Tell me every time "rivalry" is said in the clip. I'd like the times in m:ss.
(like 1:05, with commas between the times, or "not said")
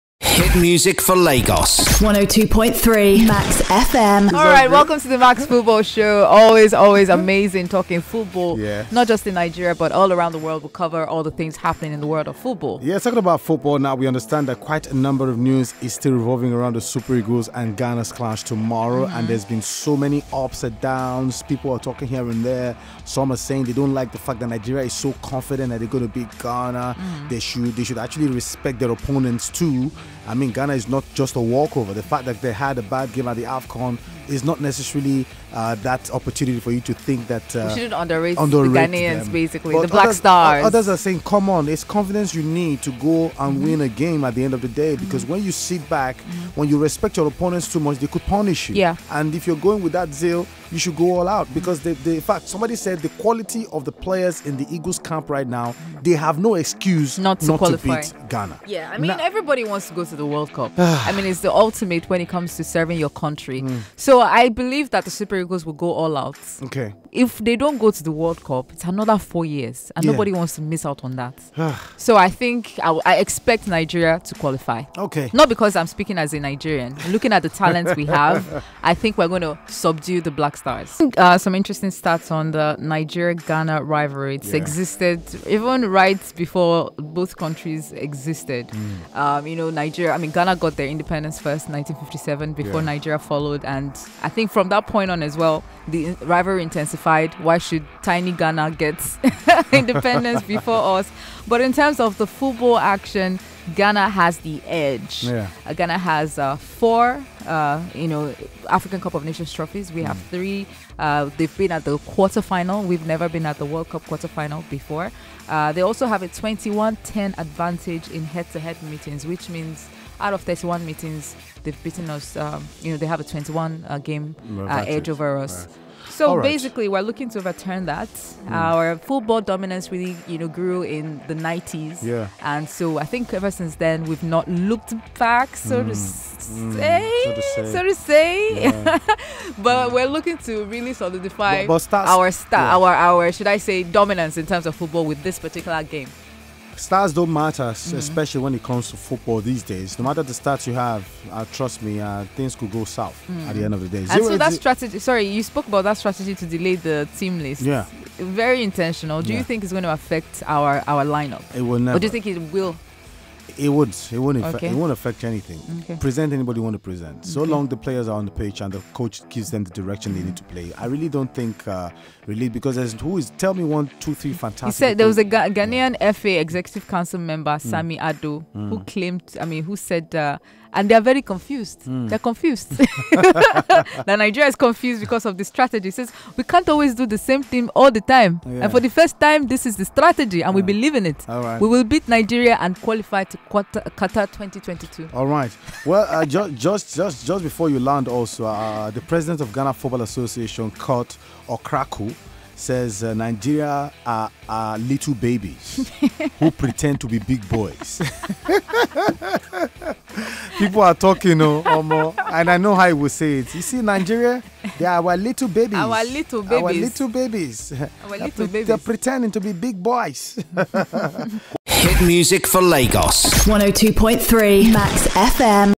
1:23, 1:36.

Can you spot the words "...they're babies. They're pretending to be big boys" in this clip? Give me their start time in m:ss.
3:38.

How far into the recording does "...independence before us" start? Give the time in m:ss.
1:39.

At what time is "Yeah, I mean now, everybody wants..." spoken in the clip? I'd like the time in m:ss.
0:58.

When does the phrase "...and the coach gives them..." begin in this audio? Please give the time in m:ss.
2:48.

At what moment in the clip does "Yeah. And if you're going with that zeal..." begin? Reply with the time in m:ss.
0:48.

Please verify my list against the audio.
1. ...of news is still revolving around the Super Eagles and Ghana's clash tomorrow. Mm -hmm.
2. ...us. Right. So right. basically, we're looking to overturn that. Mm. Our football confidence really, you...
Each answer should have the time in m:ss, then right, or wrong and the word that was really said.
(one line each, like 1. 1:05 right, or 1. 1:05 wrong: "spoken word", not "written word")
1. 0:15 right
2. 2:05 wrong: "dominance", not "confidence".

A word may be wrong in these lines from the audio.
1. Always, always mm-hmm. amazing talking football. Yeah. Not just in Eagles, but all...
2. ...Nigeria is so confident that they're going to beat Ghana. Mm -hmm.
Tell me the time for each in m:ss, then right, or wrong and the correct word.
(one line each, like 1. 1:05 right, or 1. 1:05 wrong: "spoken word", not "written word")
1. 0:06 wrong: "Nigeria", not "Eagles"
2. 0:24 right.